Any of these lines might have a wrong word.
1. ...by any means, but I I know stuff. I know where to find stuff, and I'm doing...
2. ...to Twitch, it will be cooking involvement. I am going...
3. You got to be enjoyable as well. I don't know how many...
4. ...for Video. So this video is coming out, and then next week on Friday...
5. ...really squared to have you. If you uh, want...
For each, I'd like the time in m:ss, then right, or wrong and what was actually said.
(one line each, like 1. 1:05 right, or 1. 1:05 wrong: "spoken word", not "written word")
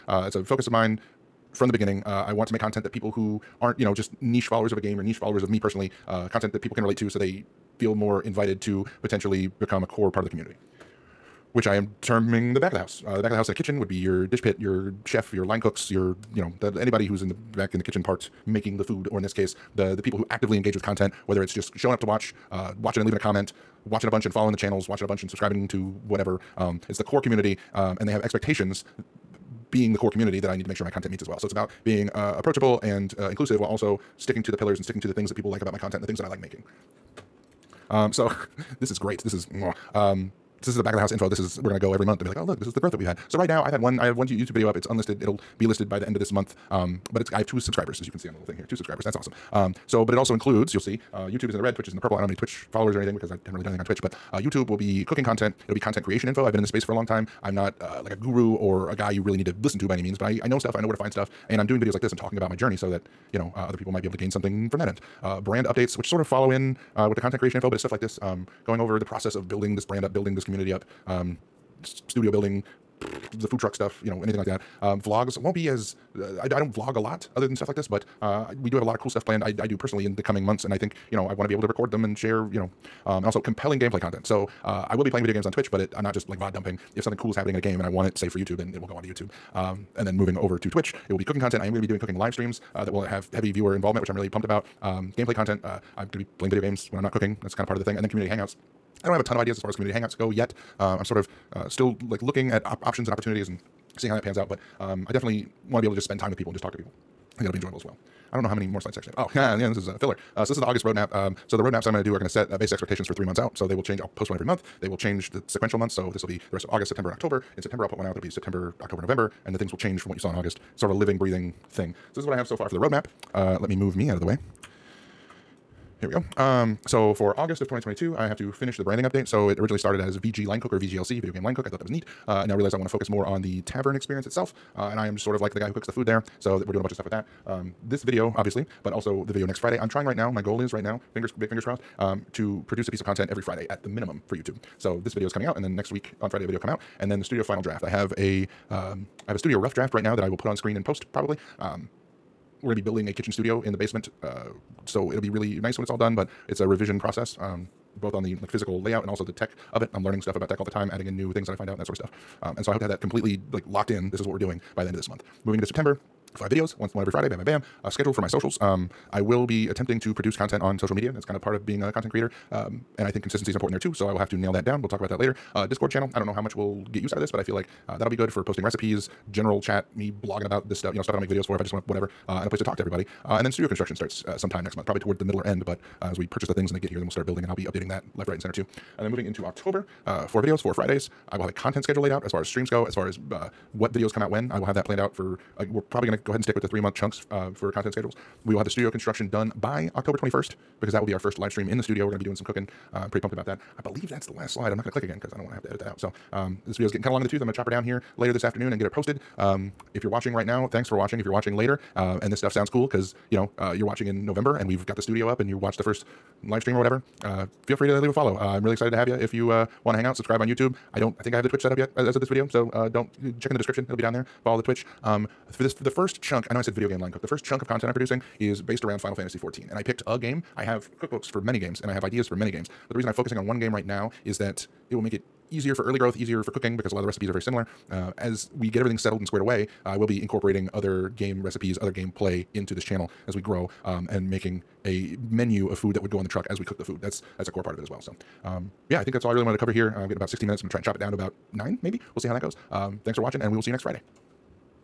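1. 0:59 right
2. 1:30 wrong: "content", not "involvement"
3. 1:47 right
4. 2:24 wrong: "YouTube", not "Video"
5. 3:38 wrong: "excited", not "squared".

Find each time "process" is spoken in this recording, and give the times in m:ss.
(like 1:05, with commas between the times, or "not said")
1:09, 2:36.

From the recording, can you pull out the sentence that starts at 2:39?
I'm learning stuff about tech all the time, adding in new things that I find out and that sort of stuff.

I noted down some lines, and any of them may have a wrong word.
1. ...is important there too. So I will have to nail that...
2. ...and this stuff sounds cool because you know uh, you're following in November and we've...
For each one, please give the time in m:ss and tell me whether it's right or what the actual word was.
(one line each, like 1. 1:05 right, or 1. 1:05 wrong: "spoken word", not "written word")
1. 2:53 right
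2. 3:32 wrong: "watching", not "following".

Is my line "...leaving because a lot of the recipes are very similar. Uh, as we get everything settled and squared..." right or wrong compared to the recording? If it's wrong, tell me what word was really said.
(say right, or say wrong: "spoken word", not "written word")
wrong: "cooking", not "leaving".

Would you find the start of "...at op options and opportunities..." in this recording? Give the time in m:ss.
1:42.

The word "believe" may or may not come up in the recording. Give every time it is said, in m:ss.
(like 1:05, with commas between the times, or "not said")
3:23.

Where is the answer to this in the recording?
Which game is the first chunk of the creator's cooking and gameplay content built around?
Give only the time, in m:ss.
3:49.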